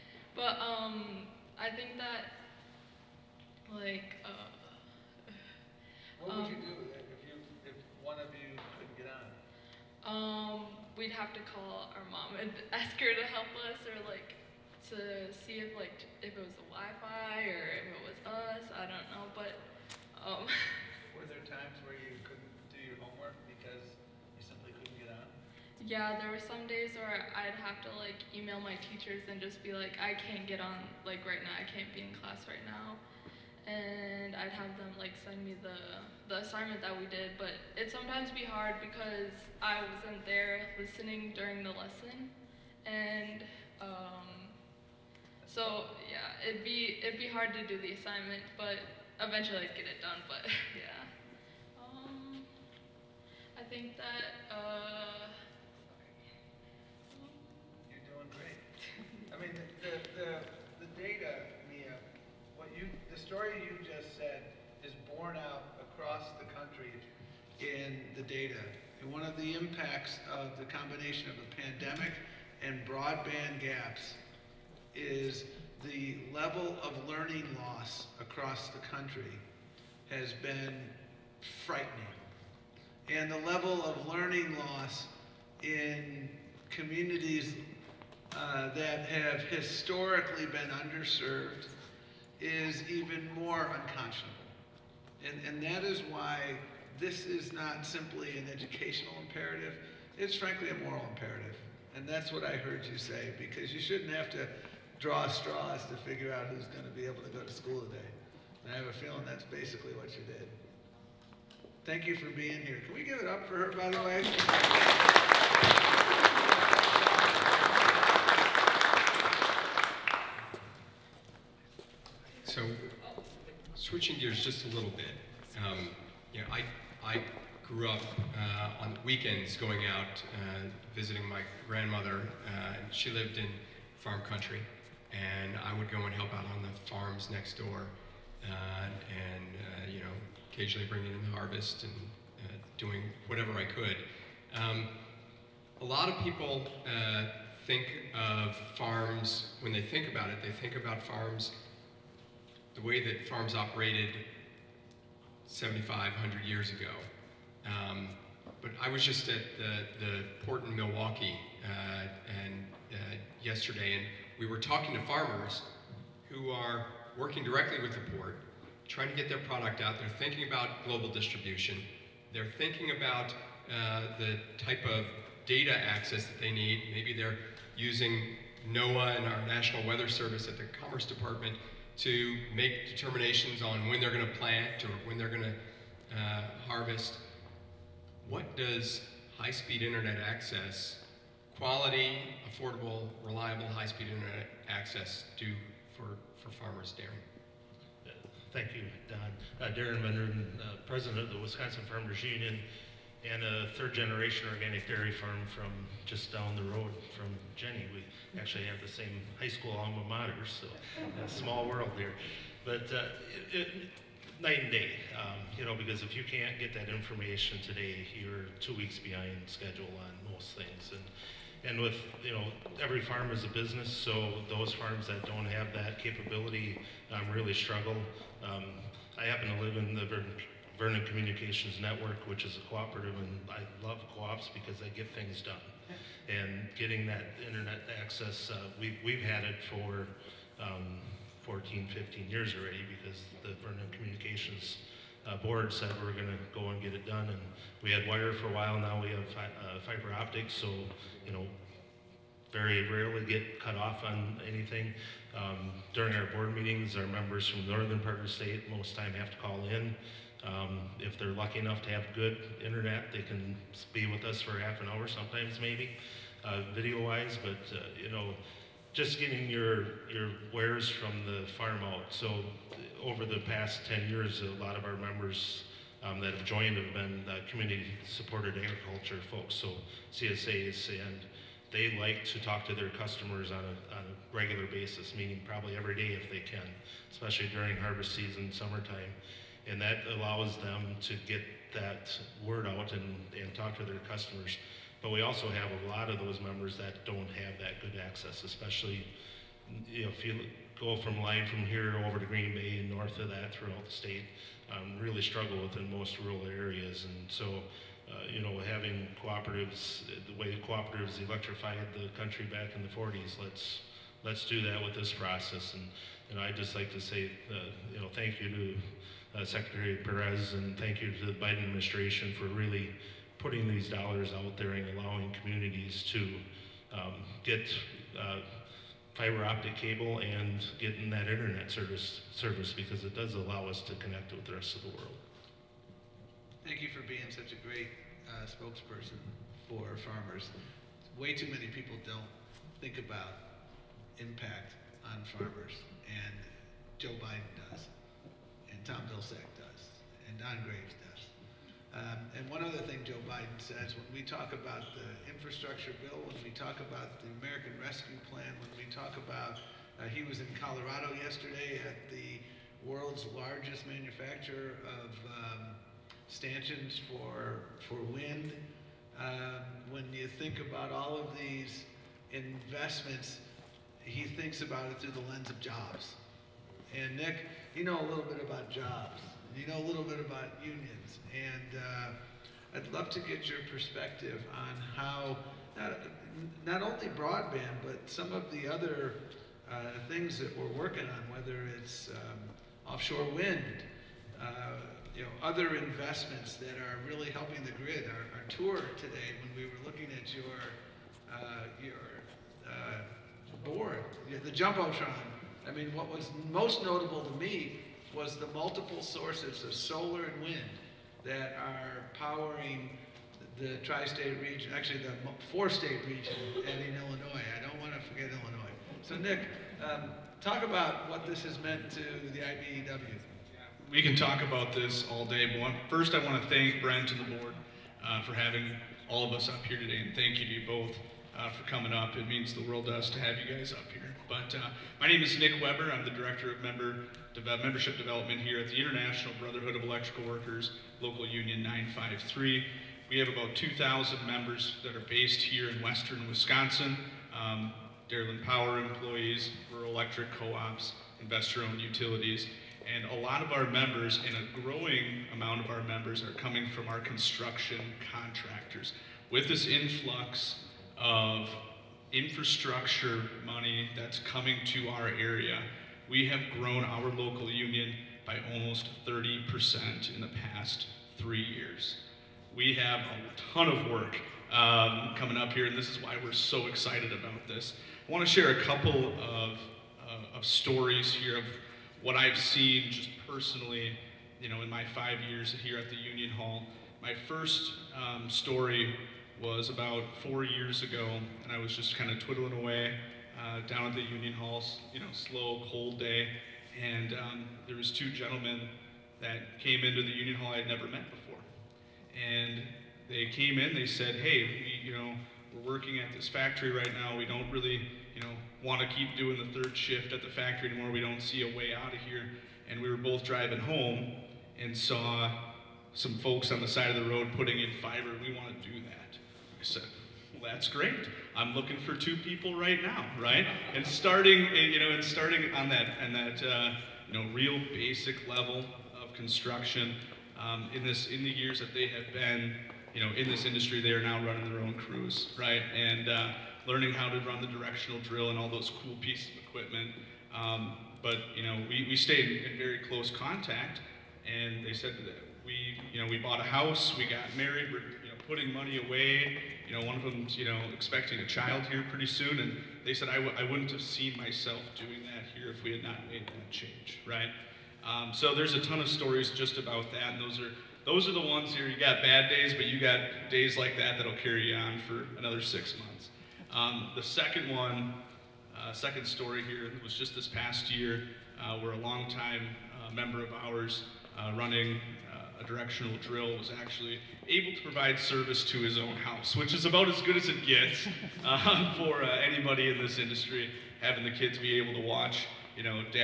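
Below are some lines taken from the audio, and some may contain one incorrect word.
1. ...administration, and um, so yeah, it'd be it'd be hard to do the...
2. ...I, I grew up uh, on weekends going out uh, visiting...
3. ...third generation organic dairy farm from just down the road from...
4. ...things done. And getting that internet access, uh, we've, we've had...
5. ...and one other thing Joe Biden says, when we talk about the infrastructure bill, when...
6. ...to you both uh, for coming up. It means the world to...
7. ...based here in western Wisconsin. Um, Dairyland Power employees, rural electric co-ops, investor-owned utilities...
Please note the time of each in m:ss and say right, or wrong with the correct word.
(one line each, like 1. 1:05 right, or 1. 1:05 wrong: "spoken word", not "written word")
1. 0:41 wrong: "lesson", not "administration"
2. 2:06 right
3. 3:23 right
4. 3:55 right
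5. 5:52 right
6. 7:10 right
7. 7:25 right.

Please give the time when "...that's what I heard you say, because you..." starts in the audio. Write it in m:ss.
1:42.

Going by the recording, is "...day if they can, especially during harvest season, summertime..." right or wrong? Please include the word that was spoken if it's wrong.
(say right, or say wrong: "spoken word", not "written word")
right.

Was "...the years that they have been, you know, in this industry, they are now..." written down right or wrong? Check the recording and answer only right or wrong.
right.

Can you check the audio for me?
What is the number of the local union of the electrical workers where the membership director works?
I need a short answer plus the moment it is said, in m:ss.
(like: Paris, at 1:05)
953, at 7:21.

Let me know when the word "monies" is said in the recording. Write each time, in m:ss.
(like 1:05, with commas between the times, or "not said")
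not said.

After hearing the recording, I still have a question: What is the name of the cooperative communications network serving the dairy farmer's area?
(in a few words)
Vernon Communications Network.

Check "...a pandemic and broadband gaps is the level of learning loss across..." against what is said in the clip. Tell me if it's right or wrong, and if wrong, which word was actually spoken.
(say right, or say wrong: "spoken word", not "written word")
right.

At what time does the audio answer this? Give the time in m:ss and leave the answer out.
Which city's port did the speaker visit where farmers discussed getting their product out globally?
2:40.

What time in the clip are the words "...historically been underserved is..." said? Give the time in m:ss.
1:29.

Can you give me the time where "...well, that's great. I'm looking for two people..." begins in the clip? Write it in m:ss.
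8:40.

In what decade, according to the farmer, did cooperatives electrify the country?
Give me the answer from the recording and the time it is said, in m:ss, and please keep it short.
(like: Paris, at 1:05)
1940s, at 5:12.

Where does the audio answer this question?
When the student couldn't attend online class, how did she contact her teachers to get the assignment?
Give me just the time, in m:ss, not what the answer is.
0:28.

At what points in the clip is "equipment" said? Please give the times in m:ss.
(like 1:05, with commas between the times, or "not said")
8:59.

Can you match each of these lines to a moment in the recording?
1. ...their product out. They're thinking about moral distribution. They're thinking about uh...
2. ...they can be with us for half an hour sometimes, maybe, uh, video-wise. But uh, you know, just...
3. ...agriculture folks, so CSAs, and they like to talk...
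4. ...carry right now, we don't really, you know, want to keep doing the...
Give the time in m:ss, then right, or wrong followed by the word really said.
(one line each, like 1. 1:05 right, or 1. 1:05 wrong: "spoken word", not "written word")
1. 2:49 wrong: "global", not "moral"
2. 4:23 right
3. 4:38 right
4. 8:26 wrong: "factory", not "carry".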